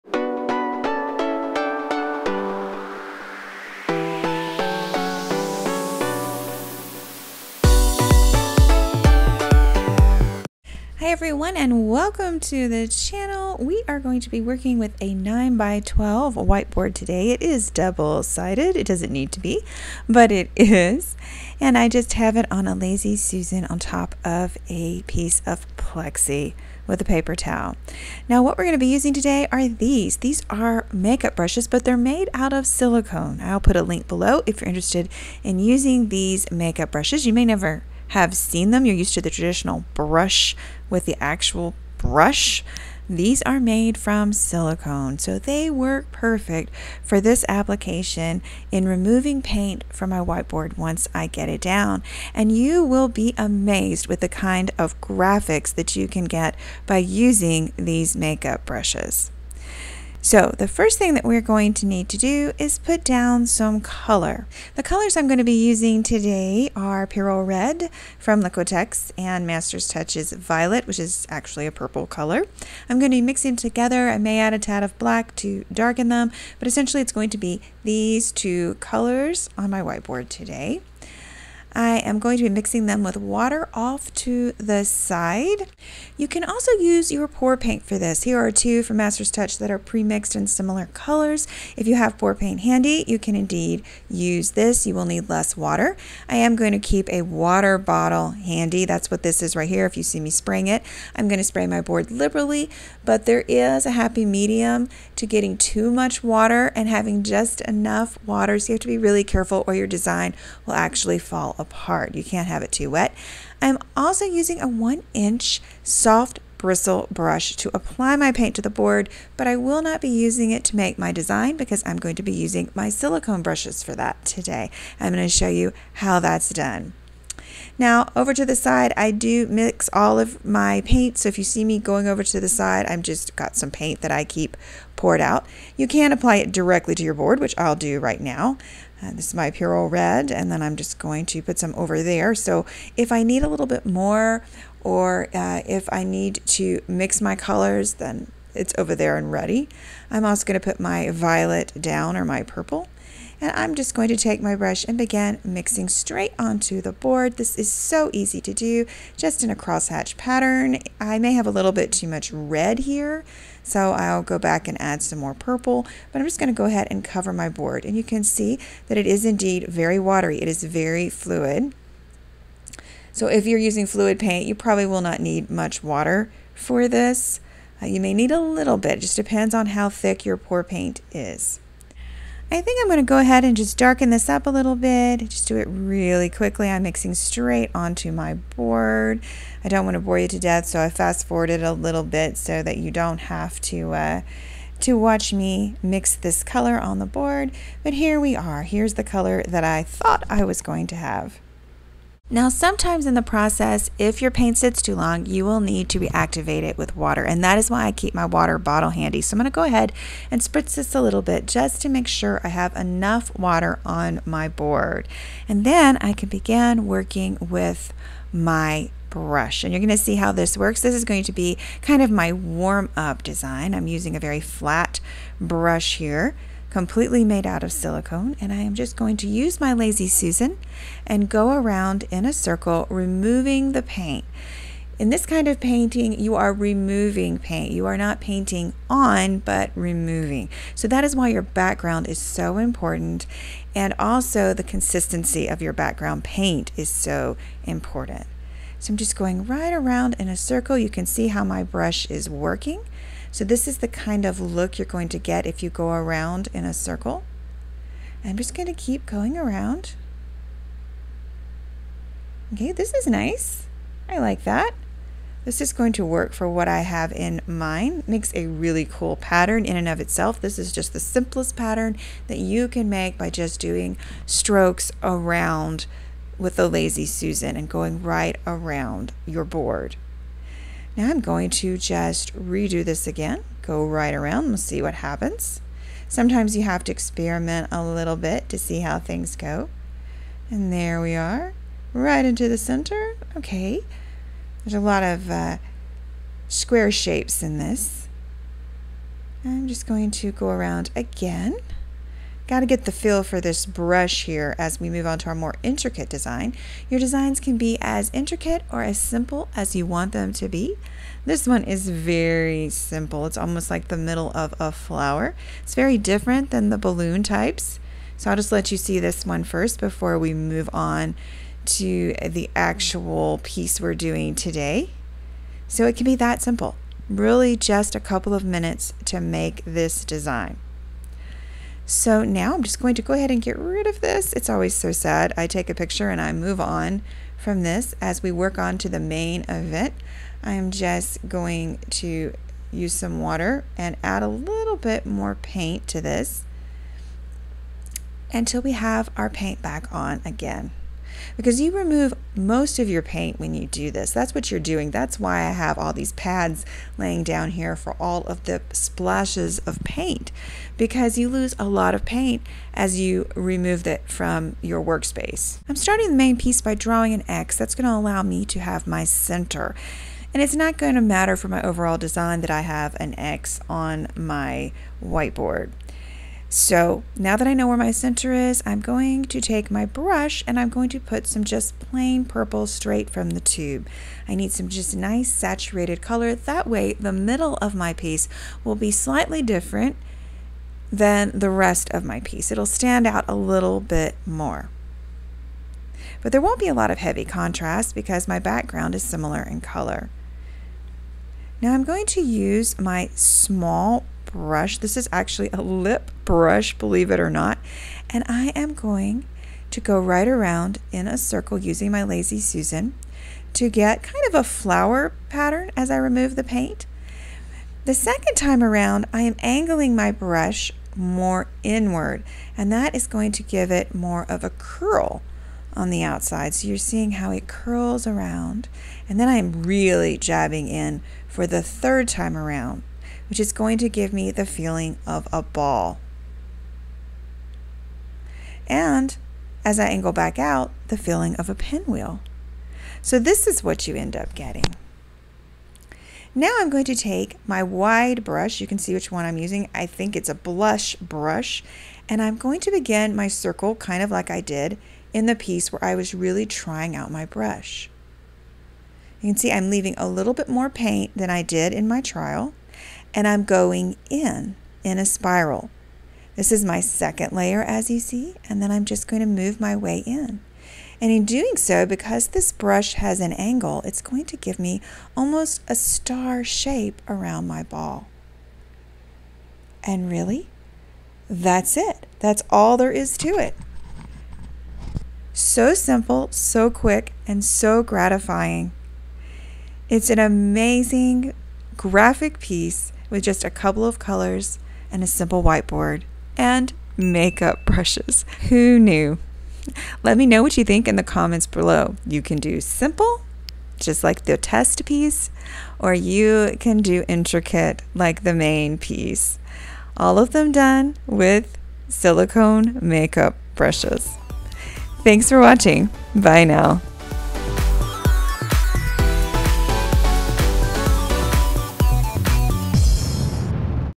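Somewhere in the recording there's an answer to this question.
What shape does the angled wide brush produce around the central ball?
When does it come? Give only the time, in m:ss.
7:55.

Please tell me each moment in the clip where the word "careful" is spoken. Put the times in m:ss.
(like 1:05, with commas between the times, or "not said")
1:49.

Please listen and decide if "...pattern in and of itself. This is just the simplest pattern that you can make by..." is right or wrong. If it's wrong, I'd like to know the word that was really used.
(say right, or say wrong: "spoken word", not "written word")
right.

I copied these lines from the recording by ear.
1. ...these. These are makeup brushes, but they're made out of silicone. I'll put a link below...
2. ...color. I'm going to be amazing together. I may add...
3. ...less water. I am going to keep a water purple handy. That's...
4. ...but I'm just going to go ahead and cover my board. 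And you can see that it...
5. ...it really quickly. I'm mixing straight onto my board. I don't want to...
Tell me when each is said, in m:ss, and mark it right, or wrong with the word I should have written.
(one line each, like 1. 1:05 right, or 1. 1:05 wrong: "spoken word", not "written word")
1. 0:29 right
2. 1:12 wrong: "mixing", not "amazing"
3. 1:35 wrong: "bottle", not "purple"
4. 2:46 right
5. 3:05 right.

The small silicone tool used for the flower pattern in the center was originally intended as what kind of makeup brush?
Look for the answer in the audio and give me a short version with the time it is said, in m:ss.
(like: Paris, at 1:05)
lip brush, at 6:45.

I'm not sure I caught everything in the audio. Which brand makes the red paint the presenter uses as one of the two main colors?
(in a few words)
Liquitex.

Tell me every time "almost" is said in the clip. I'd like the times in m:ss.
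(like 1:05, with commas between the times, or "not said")
5:13, 7:55.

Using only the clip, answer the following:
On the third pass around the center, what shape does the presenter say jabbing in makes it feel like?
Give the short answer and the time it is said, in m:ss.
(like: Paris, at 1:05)
a ball, at 7:15.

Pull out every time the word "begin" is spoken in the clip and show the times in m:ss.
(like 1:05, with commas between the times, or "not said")
2:34, 3:36, 7:32.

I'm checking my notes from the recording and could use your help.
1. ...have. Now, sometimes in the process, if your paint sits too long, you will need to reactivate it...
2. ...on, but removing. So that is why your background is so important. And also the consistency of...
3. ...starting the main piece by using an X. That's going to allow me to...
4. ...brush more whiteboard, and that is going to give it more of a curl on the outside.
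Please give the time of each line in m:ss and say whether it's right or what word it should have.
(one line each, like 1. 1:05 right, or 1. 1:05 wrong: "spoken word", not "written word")
1. 3:20 right
2. 3:58 right
3. 6:05 wrong: "drawing", not "using"
4. 7:00 wrong: "inward", not "whiteboard".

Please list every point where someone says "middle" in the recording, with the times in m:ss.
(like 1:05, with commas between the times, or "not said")
5:13, 6:27.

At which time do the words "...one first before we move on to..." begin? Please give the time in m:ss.
5:19.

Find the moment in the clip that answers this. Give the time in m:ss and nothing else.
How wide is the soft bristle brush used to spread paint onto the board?
1:54.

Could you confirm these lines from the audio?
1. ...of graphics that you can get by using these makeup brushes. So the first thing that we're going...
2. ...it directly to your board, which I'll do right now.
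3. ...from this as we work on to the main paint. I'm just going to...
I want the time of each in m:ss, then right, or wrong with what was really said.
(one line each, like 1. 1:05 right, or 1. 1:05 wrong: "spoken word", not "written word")
1. 0:54 right
2. 2:16 right
3. 5:37 wrong: "event", not "paint".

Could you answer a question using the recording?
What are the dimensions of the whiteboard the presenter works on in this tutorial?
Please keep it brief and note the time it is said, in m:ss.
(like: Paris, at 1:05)
9 by 12, at 0:15.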